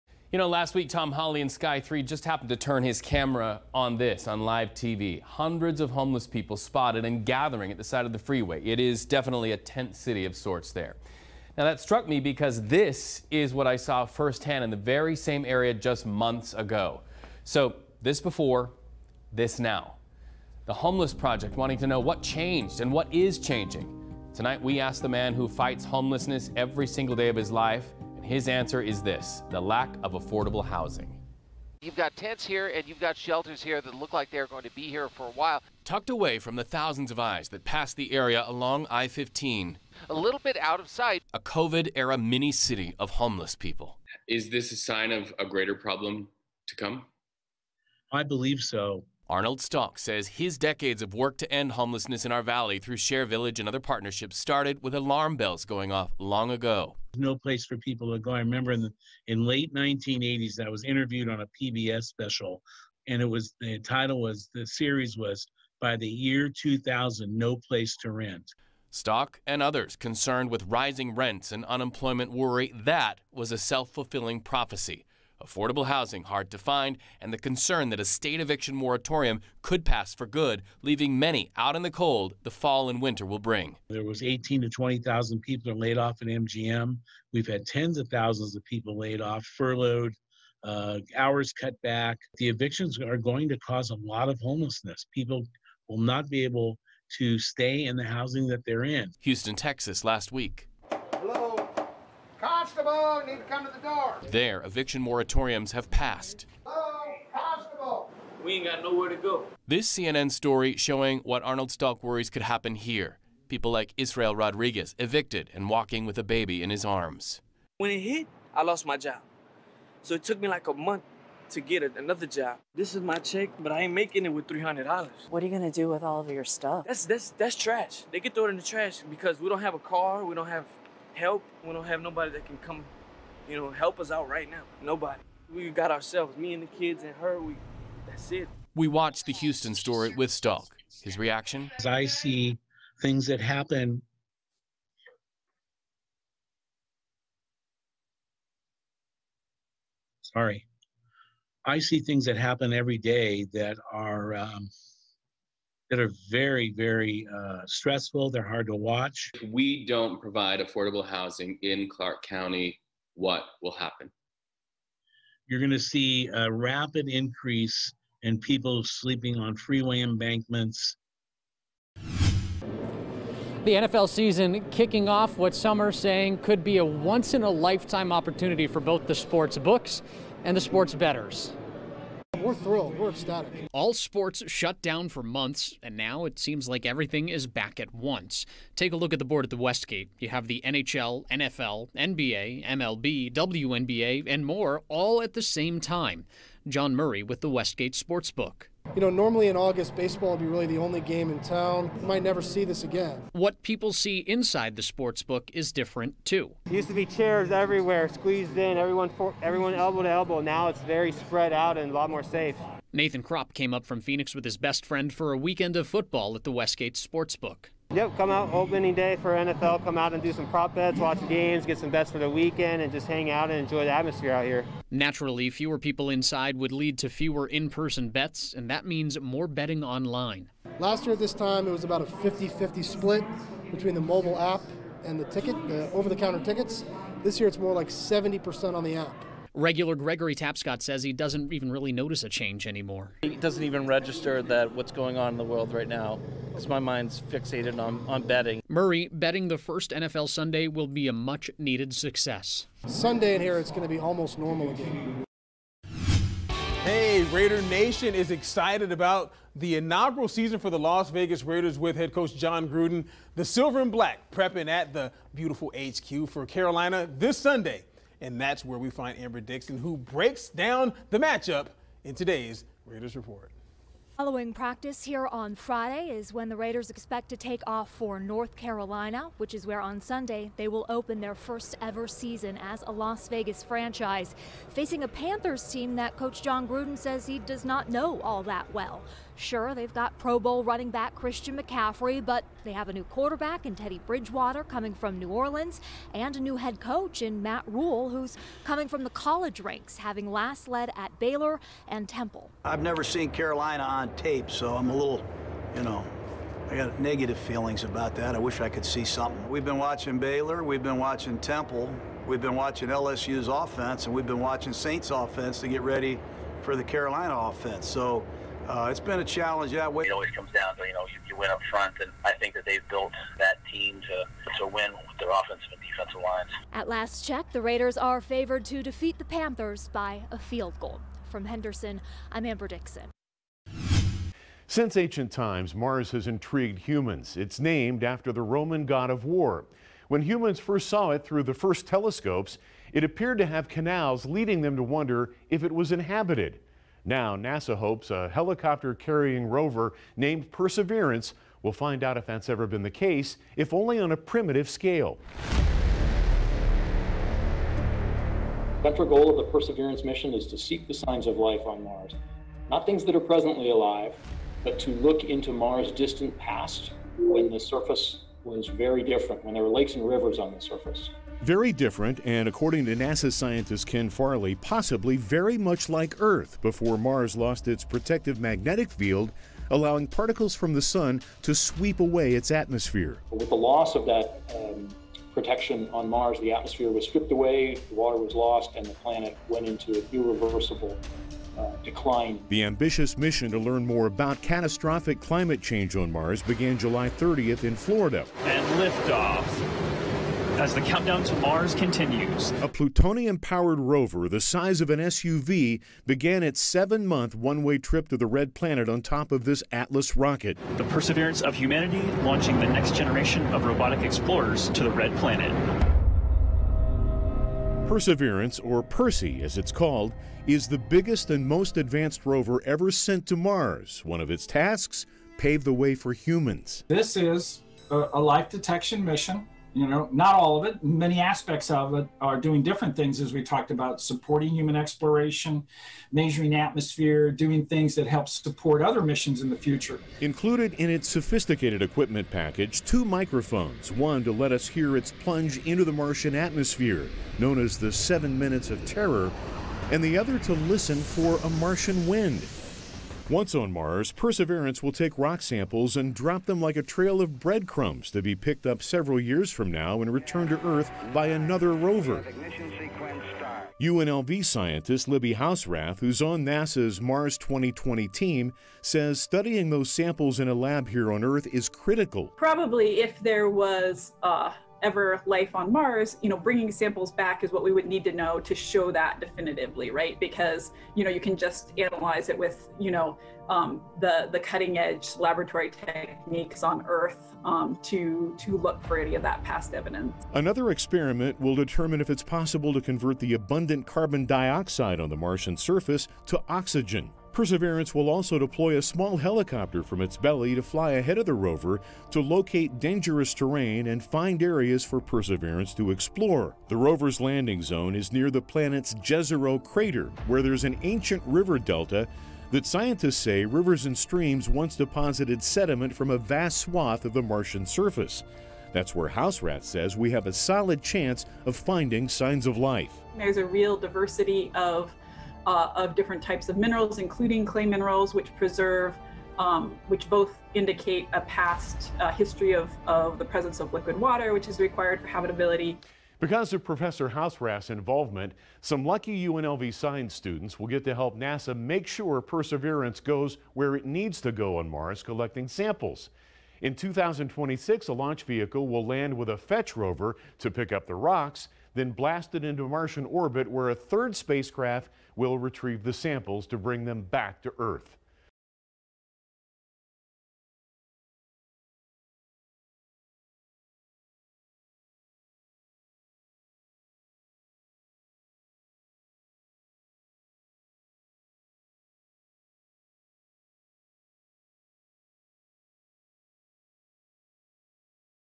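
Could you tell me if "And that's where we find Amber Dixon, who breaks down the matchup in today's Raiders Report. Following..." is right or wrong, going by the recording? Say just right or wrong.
right.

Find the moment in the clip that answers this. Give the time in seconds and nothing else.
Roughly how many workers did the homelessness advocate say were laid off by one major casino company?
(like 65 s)
84 s.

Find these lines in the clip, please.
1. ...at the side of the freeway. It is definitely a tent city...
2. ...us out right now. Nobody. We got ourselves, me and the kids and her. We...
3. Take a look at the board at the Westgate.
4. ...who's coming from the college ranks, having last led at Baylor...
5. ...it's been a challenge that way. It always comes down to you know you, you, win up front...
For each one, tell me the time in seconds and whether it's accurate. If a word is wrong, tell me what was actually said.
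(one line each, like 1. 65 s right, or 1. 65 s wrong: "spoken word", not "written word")
1. 7 s right
2. 133 s right
3. 188 s right
4. 298 s right
5. 318 s right.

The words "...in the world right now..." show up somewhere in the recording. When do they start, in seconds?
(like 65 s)
245 s.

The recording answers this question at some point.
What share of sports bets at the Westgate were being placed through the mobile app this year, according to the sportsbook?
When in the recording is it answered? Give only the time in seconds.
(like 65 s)
237 s.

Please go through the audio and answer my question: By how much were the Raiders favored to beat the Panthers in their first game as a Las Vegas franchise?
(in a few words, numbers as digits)
a field goal.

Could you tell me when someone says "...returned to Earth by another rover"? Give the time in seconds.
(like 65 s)
460 s.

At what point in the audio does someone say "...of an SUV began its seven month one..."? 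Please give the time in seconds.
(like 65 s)
404 s.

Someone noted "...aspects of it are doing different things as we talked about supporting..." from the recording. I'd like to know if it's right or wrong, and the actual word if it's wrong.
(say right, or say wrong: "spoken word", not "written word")
right.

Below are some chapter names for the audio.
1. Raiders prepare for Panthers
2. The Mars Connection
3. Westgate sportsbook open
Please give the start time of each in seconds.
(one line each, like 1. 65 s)
1. 256 s
2. 334 s
3. 172 s.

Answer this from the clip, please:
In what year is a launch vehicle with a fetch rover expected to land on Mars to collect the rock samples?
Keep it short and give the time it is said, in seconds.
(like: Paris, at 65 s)
2026, at 546 s.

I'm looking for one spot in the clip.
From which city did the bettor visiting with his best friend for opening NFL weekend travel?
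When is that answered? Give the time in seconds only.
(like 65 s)
214 s.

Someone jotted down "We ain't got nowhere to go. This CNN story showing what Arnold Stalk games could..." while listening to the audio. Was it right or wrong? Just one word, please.
wrong.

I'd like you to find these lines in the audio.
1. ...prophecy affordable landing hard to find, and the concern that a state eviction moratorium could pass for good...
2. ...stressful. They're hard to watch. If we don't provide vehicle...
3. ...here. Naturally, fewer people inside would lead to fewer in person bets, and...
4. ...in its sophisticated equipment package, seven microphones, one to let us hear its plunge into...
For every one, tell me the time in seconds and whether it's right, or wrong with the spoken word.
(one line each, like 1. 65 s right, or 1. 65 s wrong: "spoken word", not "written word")
1. 74 s wrong: "housing", not "landing"
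2. 157 s wrong: "affordable", not "vehicle"
3. 224 s right
4. 440 s wrong: "two", not "seven".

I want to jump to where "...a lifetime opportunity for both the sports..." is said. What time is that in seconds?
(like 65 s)
177 s.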